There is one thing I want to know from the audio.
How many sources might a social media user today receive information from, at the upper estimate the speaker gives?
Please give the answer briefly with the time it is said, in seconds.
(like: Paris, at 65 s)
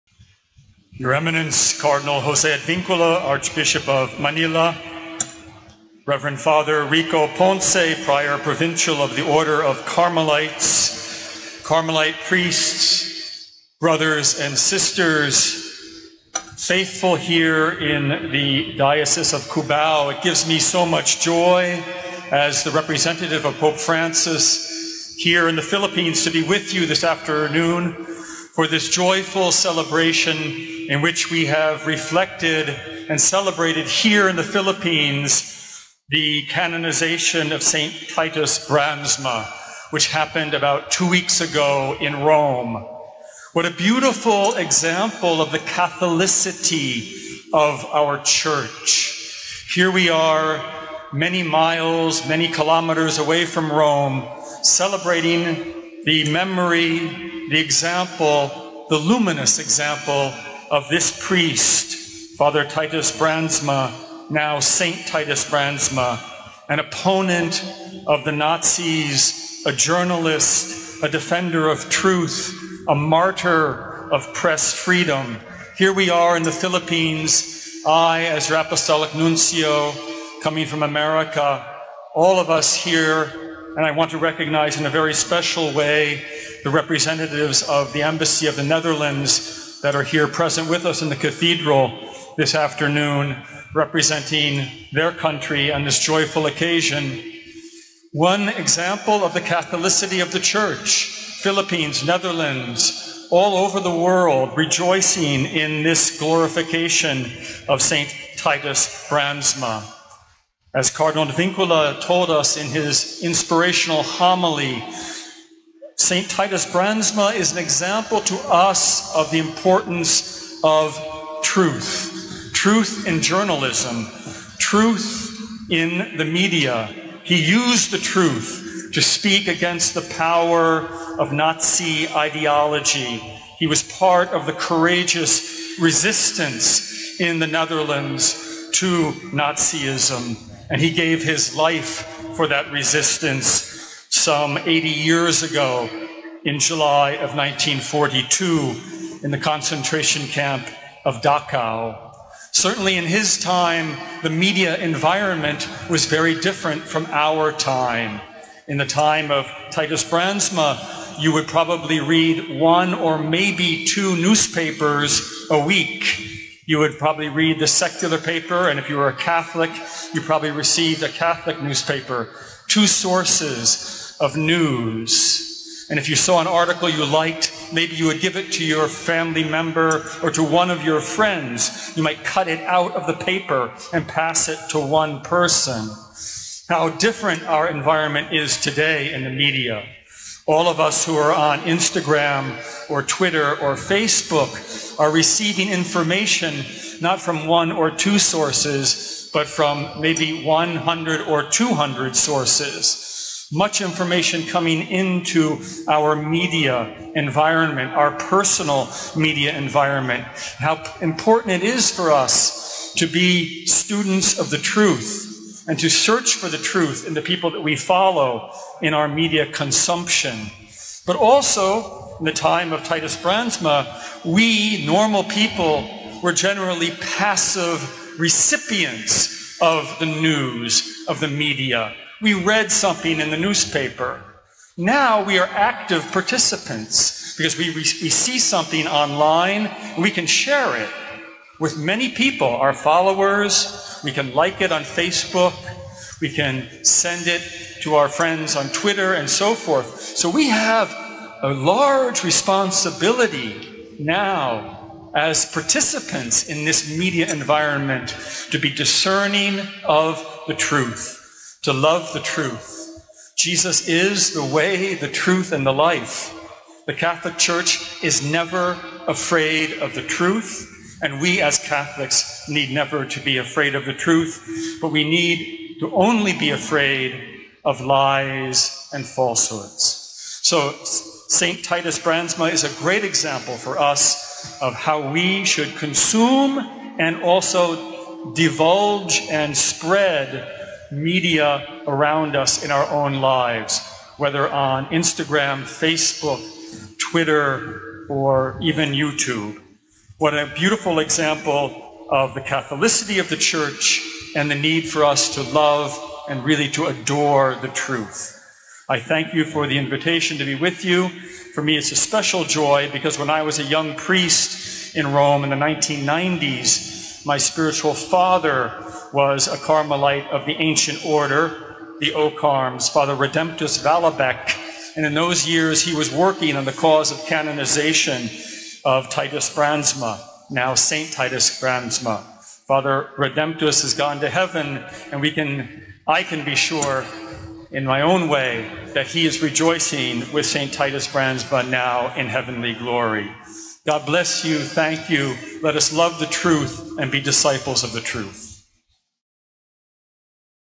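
200, at 201 s.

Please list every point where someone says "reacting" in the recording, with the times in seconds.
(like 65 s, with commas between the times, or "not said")
not said.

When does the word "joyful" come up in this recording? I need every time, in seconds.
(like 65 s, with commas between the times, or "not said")
28 s, 95 s.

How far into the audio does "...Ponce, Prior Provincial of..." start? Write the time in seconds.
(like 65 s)
7 s.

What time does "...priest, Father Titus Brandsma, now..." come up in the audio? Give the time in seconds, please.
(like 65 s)
61 s.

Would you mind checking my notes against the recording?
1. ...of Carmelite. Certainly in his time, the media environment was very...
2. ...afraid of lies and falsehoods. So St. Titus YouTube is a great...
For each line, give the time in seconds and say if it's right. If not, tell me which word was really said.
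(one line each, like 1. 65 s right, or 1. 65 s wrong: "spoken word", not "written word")
1. 151 s wrong: "Dachau", not "Carmelite"
2. 276 s wrong: "Brandsma", not "YouTube".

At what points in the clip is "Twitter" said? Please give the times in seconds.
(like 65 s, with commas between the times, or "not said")
193 s, 248 s, 296 s.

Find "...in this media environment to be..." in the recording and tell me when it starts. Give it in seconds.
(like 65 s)
256 s.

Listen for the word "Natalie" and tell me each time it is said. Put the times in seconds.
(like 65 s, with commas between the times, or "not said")
not said.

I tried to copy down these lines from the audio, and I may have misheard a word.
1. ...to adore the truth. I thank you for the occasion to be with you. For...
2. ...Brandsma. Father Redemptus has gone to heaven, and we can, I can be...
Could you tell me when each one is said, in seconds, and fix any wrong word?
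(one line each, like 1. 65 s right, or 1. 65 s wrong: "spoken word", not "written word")
1. 306 s wrong: "invitation", not "occasion"
2. 331 s right.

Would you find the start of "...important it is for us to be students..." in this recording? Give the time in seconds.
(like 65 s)
211 s.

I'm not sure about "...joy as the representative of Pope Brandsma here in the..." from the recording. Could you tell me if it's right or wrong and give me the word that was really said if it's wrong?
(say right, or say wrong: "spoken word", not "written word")
wrong: "Francis", not "Brandsma".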